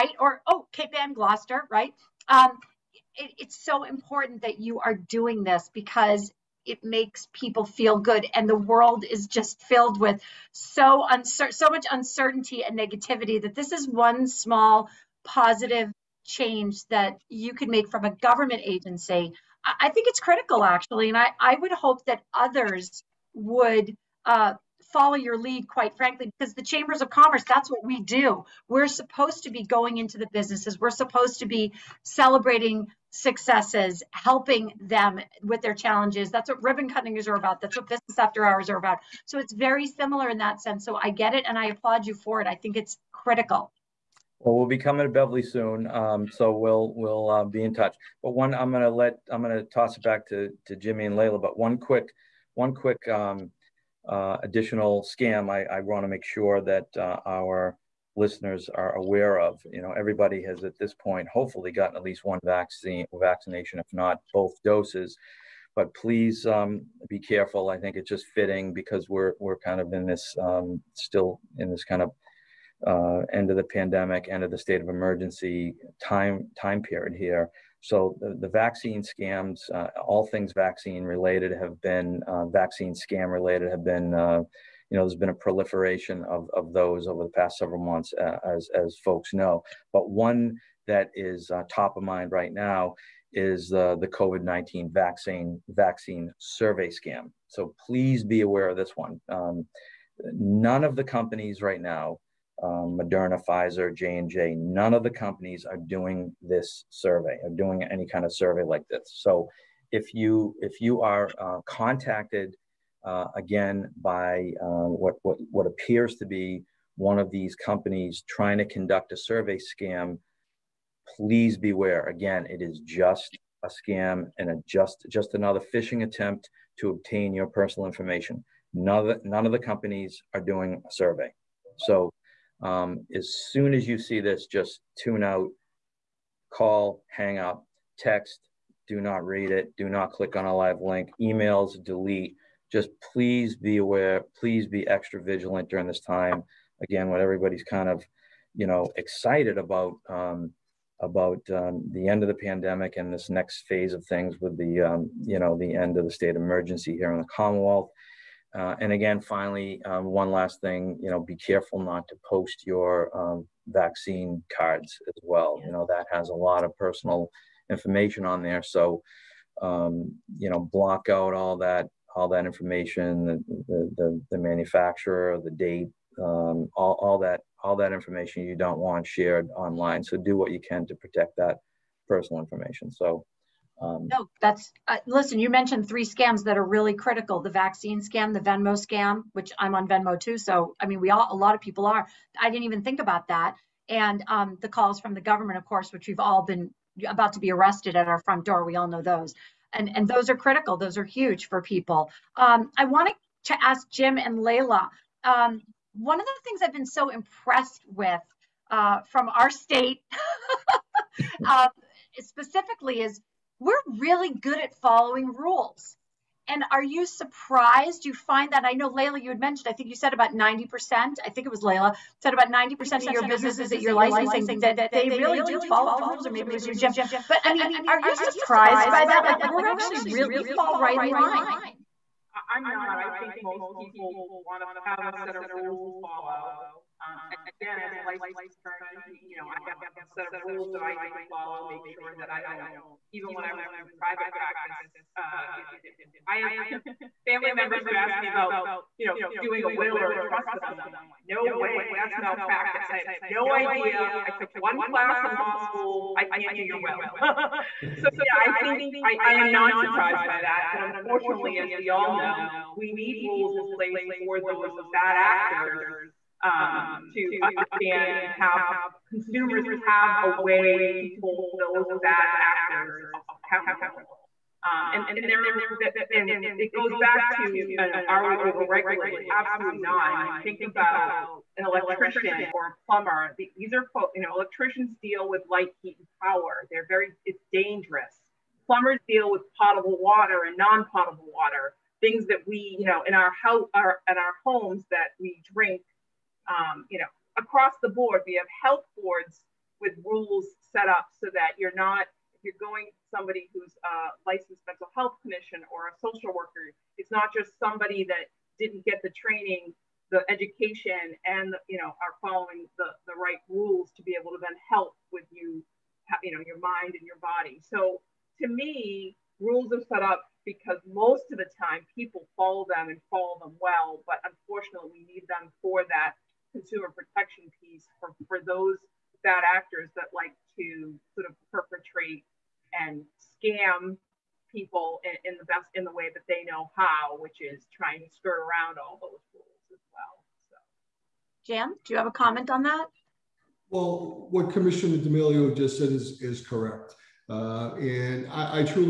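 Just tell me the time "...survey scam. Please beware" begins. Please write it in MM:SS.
01:59.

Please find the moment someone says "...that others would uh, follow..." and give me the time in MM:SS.
00:22.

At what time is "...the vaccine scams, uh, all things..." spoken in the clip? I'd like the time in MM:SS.
01:18.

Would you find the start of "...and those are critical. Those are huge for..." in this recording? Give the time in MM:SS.
03:19.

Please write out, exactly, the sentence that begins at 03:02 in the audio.
So um, no, that's uh, listen.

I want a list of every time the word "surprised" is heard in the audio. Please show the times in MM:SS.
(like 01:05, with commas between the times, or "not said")
03:37, 03:48, 04:19.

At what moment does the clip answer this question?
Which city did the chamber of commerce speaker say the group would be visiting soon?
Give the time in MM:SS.
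00:45.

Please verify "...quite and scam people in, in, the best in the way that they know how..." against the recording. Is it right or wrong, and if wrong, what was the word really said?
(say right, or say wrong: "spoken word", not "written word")
wrong: "perpetrate", not "quite".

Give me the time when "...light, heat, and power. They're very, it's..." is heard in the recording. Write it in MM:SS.
04:45.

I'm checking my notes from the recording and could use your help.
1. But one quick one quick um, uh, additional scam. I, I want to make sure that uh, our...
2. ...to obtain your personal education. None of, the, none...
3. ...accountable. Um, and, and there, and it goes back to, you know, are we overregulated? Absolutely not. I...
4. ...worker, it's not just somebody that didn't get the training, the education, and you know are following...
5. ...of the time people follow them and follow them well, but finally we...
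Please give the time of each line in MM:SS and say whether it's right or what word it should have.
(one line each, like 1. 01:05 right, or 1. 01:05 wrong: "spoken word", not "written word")
1. 00:51 right
2. 02:06 wrong: "information", not "education"
3. 04:33 right
4. 05:06 right
5. 05:21 wrong: "unfortunately", not "finally".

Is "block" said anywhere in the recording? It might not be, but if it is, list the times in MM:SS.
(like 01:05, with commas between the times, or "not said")
02:50.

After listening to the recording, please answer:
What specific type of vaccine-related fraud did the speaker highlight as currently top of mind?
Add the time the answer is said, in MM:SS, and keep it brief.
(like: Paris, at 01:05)
COVID-19 vaccine survey scam, at 01:34.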